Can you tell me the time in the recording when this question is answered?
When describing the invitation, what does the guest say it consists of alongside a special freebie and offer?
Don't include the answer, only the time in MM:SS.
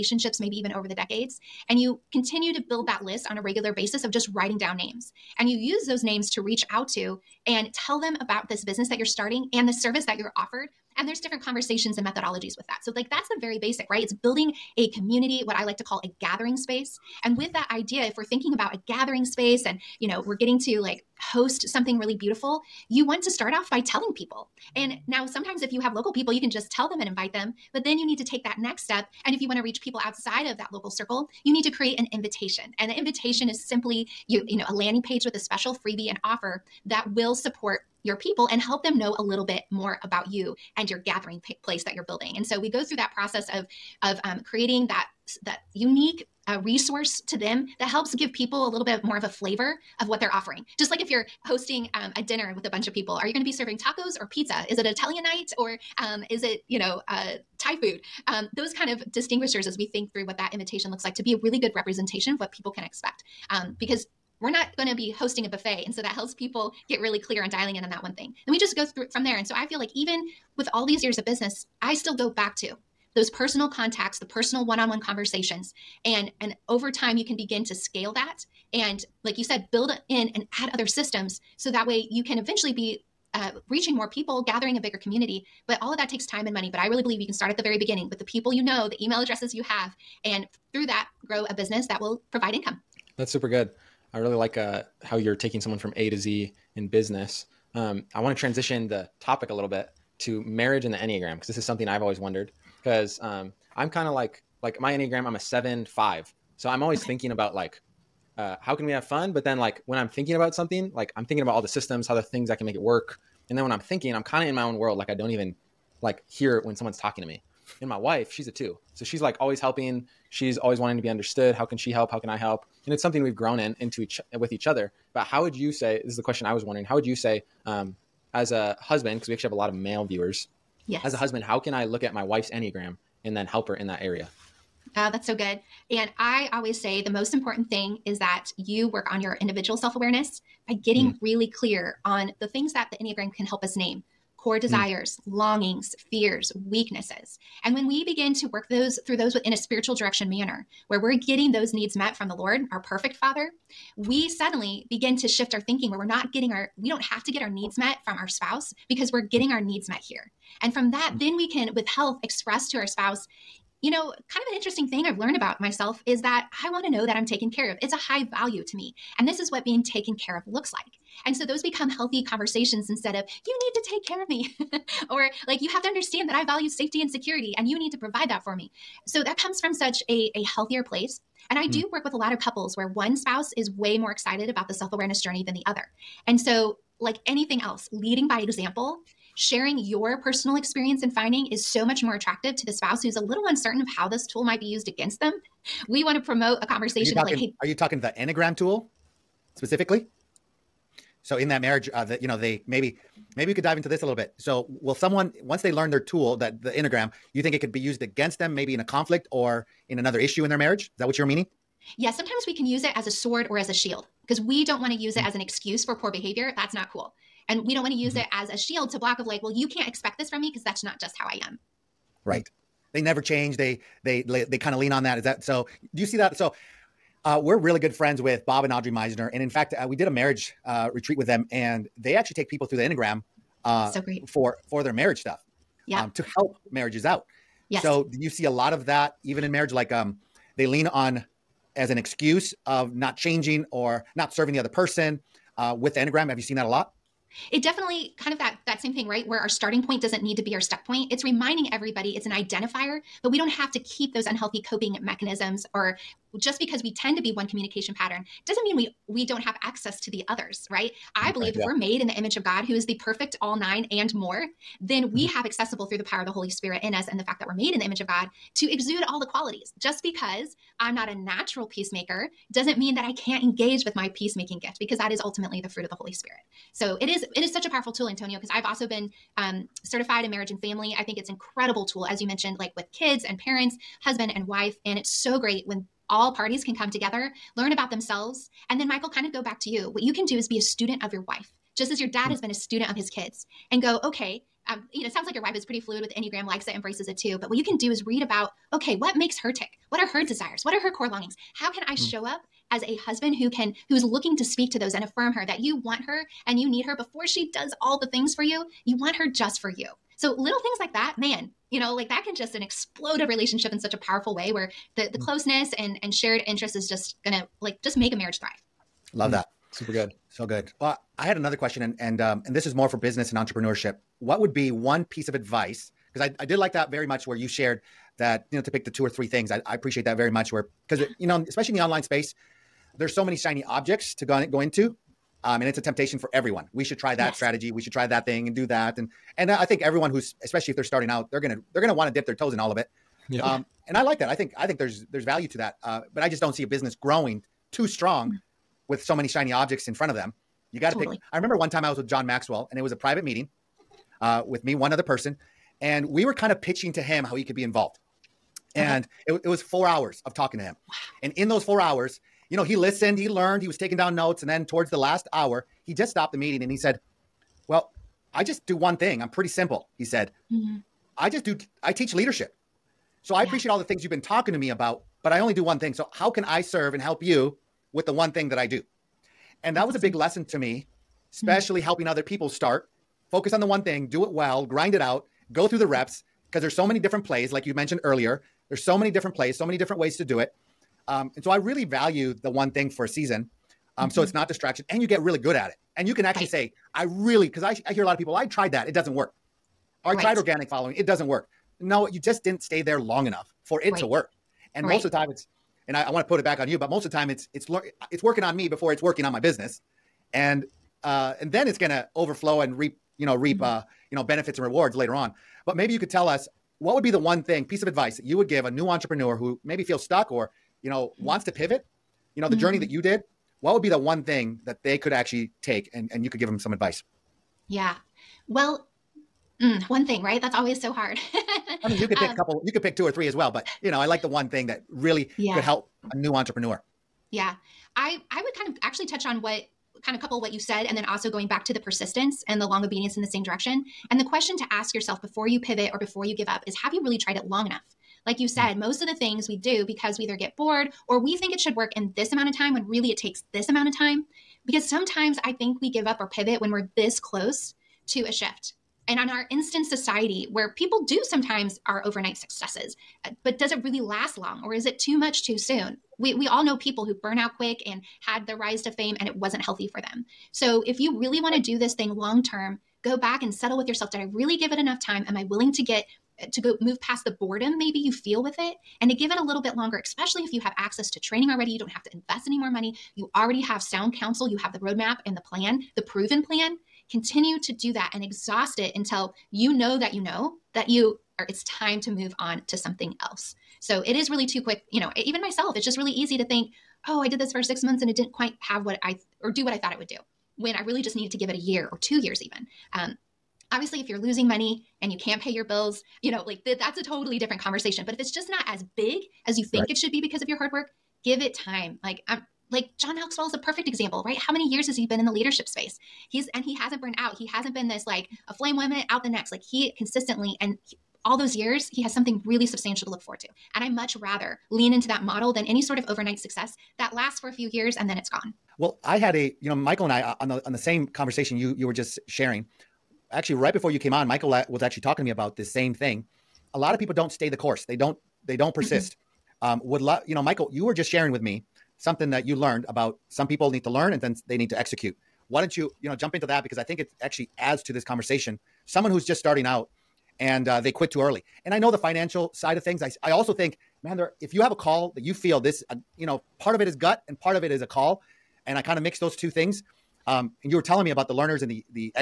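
00:34.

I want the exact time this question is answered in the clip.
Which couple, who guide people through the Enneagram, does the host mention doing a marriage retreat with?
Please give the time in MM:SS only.
03:48.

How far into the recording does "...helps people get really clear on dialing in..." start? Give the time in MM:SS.
01:06.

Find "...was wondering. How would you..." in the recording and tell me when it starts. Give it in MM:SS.
02:06.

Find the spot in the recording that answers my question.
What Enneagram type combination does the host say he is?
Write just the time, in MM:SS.
01:45.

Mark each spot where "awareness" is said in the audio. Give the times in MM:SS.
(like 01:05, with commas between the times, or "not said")
02:19, 03:04.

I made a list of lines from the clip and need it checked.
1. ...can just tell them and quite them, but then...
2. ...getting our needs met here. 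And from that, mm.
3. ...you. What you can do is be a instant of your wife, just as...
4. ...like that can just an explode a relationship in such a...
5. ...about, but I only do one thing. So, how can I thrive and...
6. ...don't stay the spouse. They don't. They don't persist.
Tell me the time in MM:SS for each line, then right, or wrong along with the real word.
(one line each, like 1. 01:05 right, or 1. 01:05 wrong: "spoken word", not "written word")
1. 00:26 wrong: "invite", not "quite"
2. 02:39 right
3. 04:49 wrong: "student", not "instant"
4. 05:11 right
5. 06:14 wrong: "serve", not "thrive"
6. 08:57 wrong: "course", not "spouse".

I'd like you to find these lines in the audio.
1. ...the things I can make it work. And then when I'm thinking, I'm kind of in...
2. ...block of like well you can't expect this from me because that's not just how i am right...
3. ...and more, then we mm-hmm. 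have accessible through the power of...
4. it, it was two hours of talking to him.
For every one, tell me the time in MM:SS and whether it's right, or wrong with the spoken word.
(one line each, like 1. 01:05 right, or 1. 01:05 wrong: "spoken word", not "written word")
1. 01:52 right
2. 03:38 right
3. 04:23 right
4. 05:59 wrong: "four", not "two".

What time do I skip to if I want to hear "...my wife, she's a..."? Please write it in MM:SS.
01:57.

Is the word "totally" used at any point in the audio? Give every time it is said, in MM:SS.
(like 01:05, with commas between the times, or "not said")
05:50, 08:27.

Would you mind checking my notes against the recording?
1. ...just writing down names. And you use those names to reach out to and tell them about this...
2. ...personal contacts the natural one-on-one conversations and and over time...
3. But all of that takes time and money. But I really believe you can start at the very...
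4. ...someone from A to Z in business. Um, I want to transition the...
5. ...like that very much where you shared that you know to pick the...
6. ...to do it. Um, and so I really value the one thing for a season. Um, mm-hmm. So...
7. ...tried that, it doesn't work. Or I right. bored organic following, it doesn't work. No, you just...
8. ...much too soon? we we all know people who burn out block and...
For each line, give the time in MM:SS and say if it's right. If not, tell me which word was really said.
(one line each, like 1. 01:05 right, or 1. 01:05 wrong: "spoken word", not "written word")
1. 00:04 right
2. 01:13 wrong: "personal", not "natural"
3. 01:25 right
4. 01:35 right
5. 05:26 right
6. 06:30 right
7. 06:38 wrong: "tried", not "bored"
8. 07:45 wrong: "quick", not "block".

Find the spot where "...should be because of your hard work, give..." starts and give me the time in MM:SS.
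08:29.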